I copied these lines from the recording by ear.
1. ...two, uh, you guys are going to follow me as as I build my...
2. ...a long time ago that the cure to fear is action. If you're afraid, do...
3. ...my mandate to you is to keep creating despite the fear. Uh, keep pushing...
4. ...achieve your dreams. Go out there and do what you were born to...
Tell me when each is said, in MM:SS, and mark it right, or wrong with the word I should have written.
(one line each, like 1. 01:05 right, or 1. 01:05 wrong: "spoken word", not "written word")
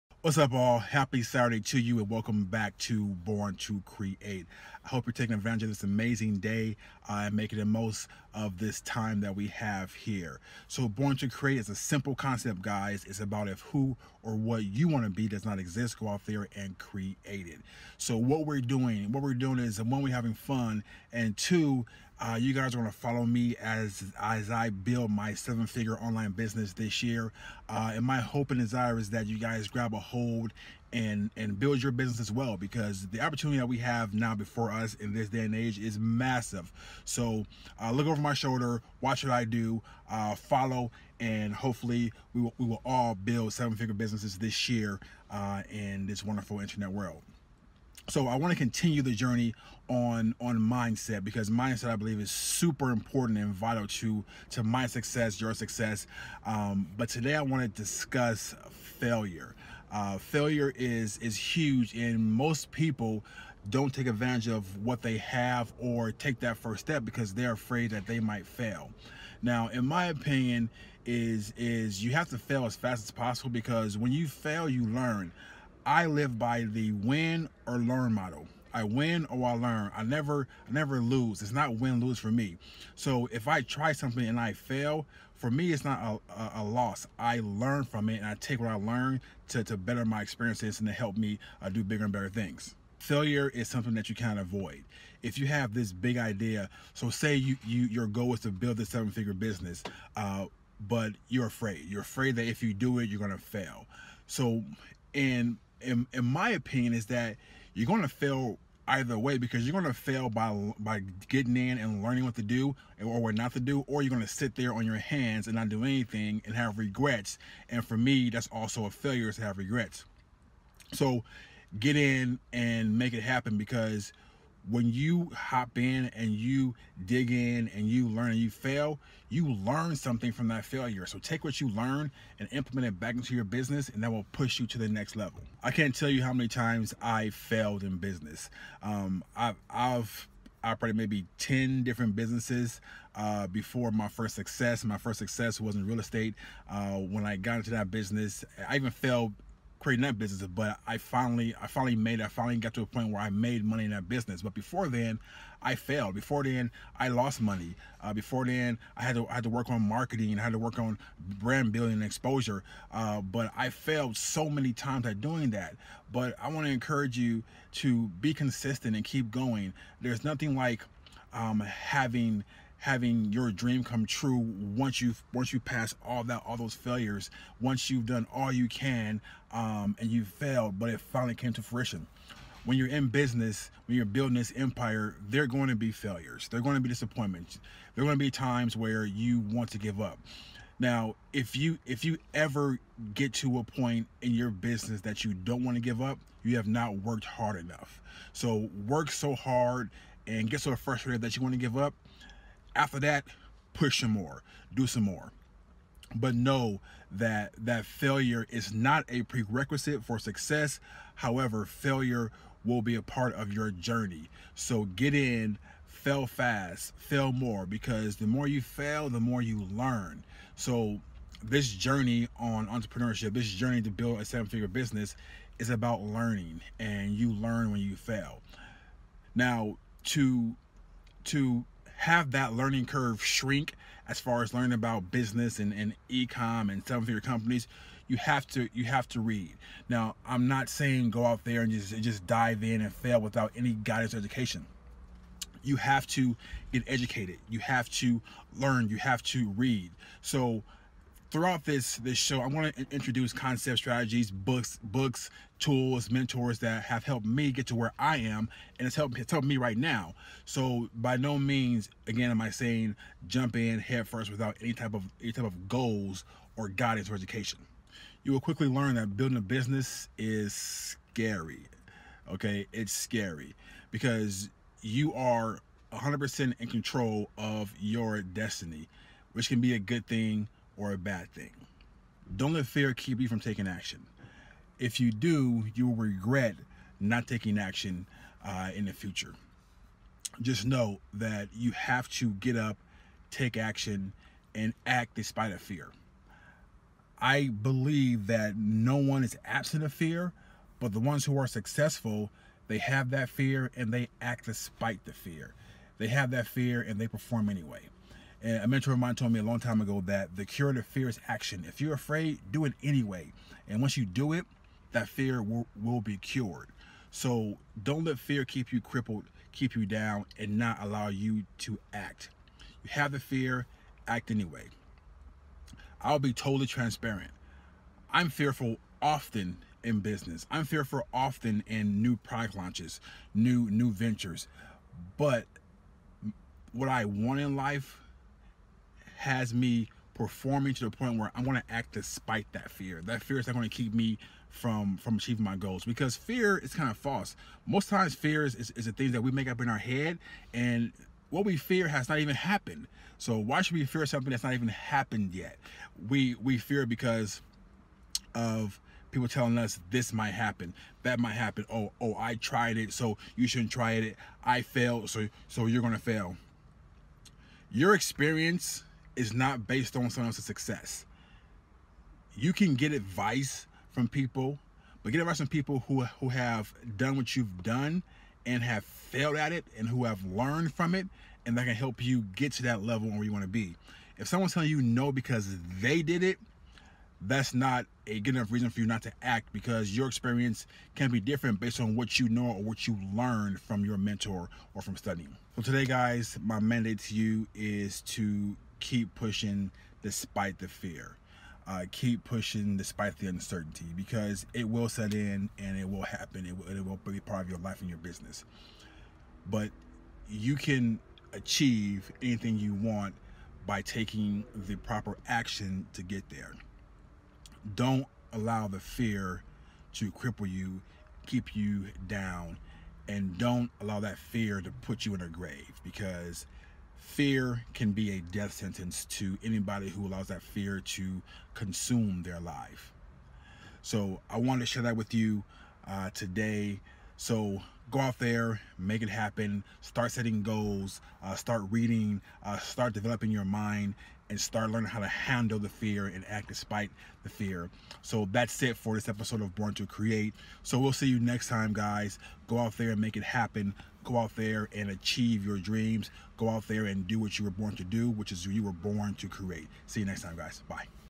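1. 00:21 right
2. 05:09 right
3. 06:36 wrong: "pushing", not "creating"
4. 07:34 right.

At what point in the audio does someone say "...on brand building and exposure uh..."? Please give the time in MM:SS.
02:40.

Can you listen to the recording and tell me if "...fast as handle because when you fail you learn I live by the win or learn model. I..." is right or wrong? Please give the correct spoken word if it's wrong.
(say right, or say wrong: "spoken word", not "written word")
wrong: "possible", not "handle".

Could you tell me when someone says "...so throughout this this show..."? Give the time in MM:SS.
04:10.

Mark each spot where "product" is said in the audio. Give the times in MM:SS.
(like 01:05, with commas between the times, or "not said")
05:32.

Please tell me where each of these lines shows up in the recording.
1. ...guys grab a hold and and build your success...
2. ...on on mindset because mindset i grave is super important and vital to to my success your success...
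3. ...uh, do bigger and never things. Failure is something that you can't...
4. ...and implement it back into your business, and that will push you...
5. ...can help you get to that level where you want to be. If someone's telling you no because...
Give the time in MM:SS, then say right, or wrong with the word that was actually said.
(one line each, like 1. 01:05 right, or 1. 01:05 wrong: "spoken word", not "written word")
1. 00:29 wrong: "business", not "success"
2. 00:49 wrong: "believe", not "grave"
3. 01:31 wrong: "better", not "never"
4. 02:12 right
5. 06:21 right.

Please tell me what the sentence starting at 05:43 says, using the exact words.
That fear is not going to keep me from from achieving my goals because fear is kind of false.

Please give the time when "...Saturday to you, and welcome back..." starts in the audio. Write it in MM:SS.
00:01.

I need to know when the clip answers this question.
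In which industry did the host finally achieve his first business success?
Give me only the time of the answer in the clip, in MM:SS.
02:25.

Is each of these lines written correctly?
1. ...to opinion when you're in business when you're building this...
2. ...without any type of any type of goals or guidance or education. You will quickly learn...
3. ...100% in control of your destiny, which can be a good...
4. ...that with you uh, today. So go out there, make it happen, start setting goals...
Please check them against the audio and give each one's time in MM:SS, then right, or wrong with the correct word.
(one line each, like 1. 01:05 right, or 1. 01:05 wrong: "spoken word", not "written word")
1. 03:01 wrong: "fruition", not "opinion"
2. 04:24 right
3. 04:35 right
4. 07:14 right.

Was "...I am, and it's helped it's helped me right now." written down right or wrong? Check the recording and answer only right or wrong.
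right.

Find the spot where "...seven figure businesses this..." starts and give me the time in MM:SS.
00:43.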